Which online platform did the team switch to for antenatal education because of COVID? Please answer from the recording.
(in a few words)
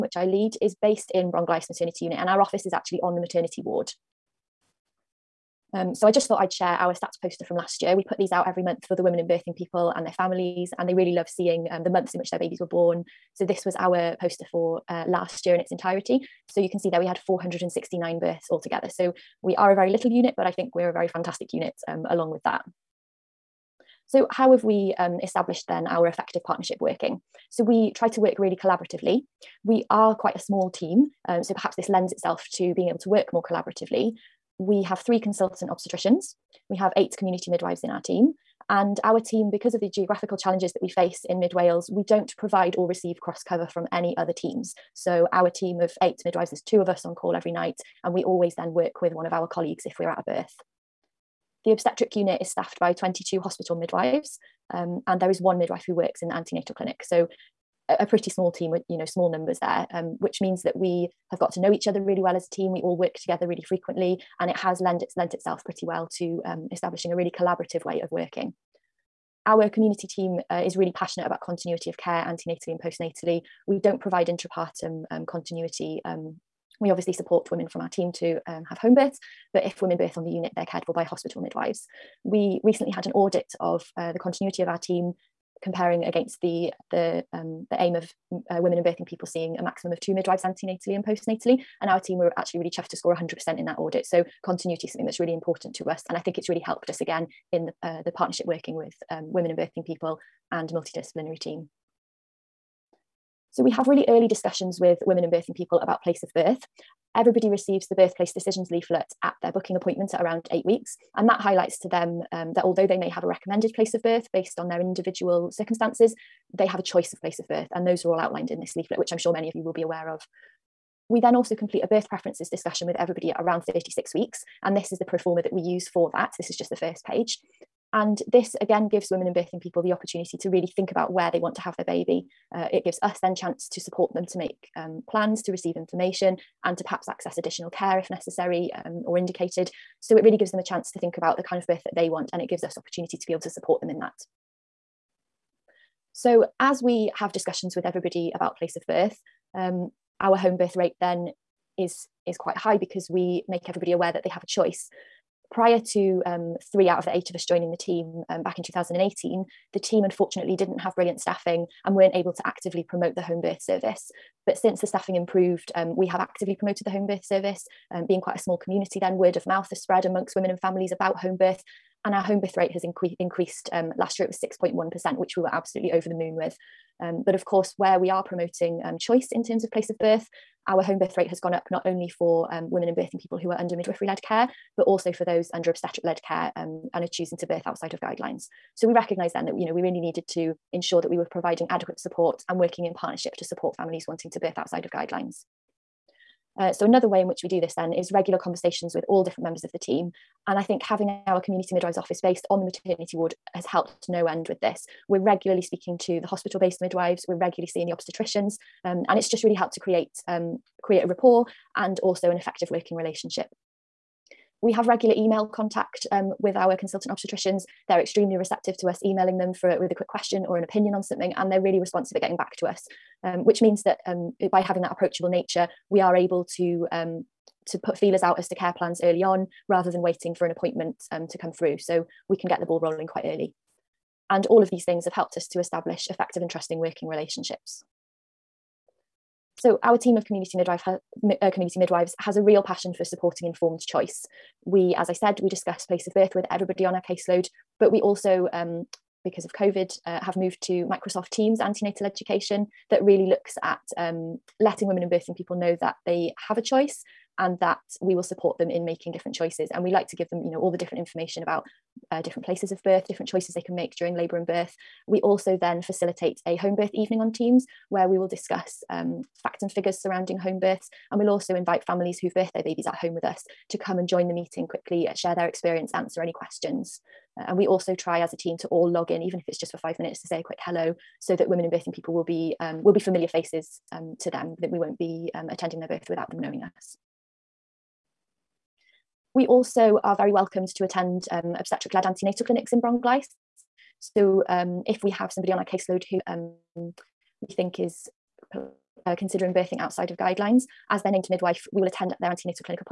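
Microsoft Teams.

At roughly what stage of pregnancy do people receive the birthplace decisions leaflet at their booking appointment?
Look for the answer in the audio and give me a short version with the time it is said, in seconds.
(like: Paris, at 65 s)
8 weeks, at 110 s.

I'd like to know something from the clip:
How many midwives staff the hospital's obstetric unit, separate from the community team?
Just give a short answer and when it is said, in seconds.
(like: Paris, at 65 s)
22, at 52 s.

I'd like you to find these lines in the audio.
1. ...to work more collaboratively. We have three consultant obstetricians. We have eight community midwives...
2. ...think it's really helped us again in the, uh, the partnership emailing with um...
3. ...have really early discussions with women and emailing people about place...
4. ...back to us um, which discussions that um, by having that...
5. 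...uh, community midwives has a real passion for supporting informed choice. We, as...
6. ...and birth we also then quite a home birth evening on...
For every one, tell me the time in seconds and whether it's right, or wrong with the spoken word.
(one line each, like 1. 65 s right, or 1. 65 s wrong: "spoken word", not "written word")
1. 32 s right
2. 96 s wrong: "working", not "emailing"
3. 103 s wrong: "birthing", not "emailing"
4. 222 s wrong: "means", not "discussions"
5. 241 s right
6. 264 s wrong: "facilitate", not "quite".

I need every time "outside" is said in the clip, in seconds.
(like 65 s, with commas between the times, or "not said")
187 s, 194 s, 299 s.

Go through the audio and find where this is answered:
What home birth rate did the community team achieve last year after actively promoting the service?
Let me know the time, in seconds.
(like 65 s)
174 s.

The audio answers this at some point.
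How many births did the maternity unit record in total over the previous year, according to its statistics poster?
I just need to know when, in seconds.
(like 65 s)
17 s.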